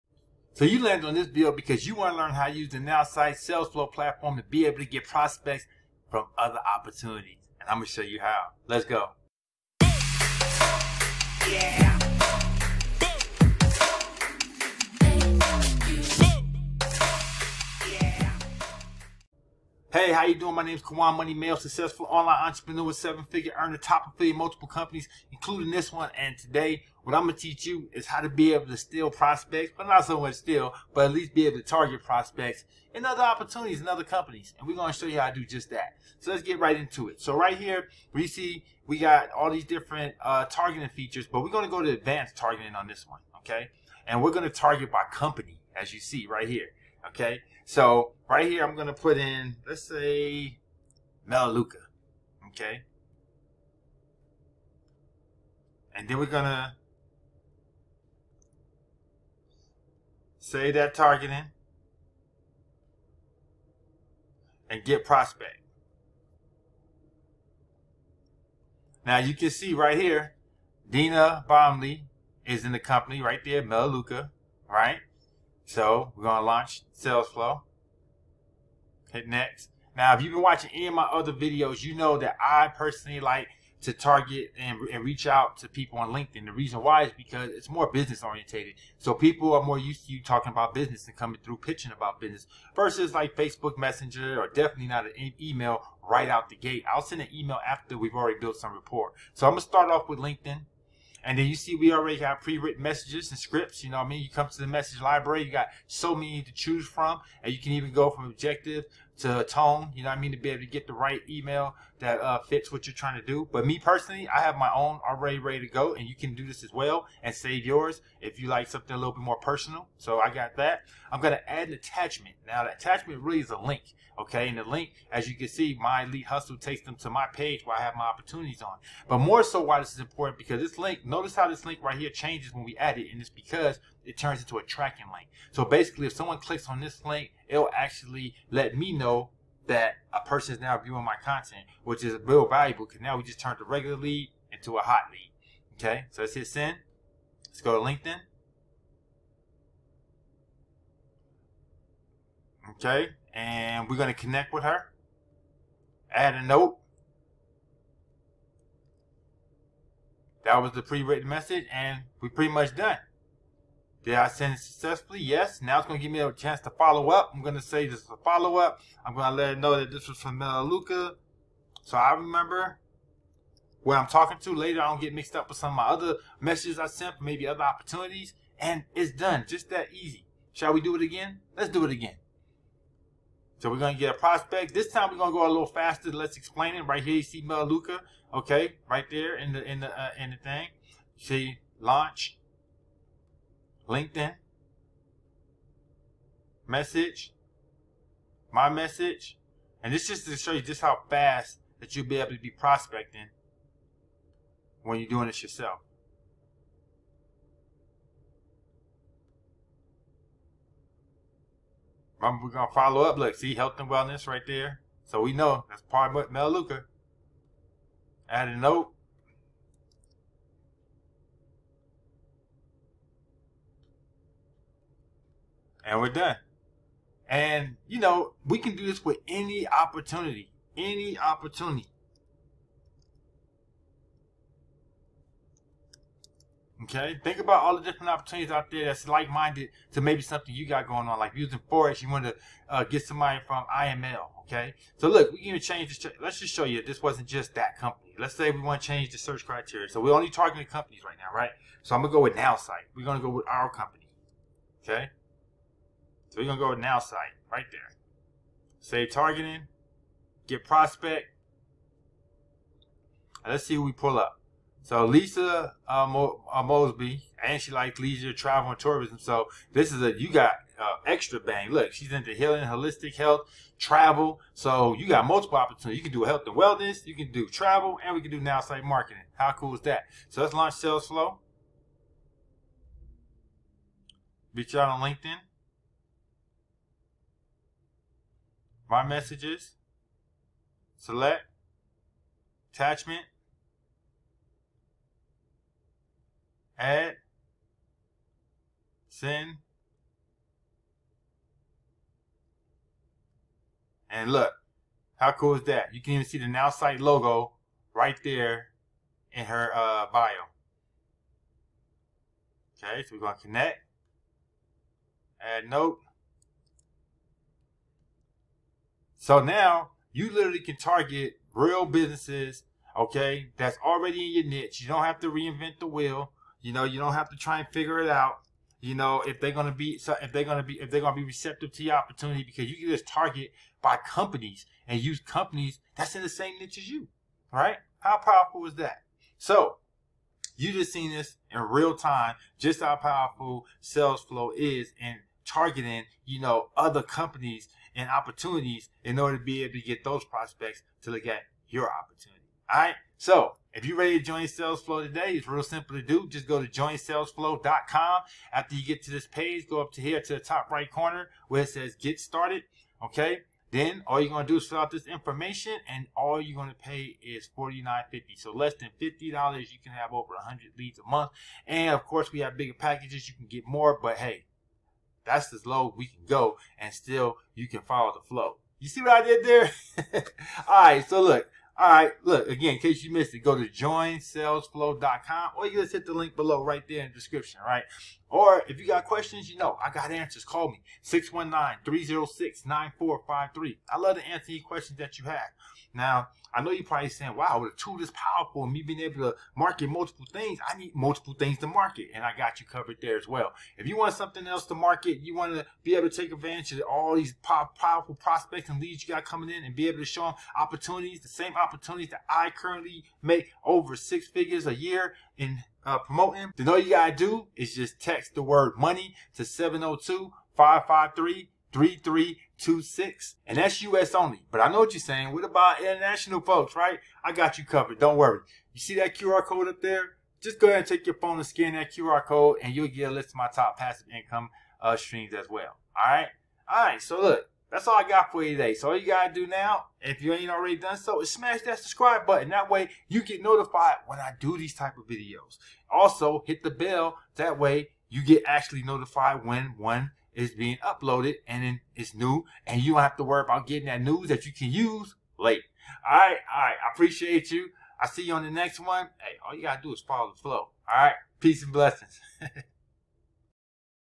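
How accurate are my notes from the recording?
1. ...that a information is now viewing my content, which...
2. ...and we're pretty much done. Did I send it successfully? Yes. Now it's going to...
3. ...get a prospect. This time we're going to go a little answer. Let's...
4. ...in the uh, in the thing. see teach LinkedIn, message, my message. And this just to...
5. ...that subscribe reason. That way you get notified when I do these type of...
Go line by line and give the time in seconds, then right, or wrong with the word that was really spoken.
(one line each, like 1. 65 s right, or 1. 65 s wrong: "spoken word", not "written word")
1. 139 s wrong: "person", not "information"
2. 161 s right
3. 183 s wrong: "faster", not "answer"
4. 189 s wrong: "launch", not "teach"
5. 441 s wrong: "button", not "reason".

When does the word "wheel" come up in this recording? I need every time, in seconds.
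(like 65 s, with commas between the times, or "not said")
325 s.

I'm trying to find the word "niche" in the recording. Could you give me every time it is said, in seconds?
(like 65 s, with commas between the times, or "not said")
324 s, 336 s.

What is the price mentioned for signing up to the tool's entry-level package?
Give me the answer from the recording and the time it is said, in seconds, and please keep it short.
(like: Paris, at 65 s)
$49.50, at 367 s.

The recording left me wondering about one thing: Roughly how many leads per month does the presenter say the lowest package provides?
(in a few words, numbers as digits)
Over 100.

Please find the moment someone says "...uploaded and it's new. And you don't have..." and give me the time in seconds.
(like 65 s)
450 s.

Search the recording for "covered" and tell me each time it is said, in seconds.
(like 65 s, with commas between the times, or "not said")
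402 s, 427 s.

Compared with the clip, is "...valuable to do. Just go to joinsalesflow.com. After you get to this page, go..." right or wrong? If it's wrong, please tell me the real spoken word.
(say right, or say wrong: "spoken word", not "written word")
wrong: "simple", not "valuable".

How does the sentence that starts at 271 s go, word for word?
Look, she's into healing, holistic health, travel.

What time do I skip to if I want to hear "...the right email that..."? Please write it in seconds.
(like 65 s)
110 s.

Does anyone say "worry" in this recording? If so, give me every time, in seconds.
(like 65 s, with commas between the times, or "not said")
428 s, 453 s.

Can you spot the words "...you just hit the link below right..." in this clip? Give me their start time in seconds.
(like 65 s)
385 s.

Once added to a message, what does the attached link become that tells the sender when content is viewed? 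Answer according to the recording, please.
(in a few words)
A tracking link.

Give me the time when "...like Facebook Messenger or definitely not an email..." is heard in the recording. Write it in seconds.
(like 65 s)
93 s.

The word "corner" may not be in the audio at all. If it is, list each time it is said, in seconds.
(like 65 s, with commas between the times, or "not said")
360 s.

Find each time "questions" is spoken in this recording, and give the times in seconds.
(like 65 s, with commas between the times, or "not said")
389 s, 394 s.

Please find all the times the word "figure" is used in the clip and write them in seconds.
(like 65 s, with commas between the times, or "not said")
22 s, 327 s, 414 s.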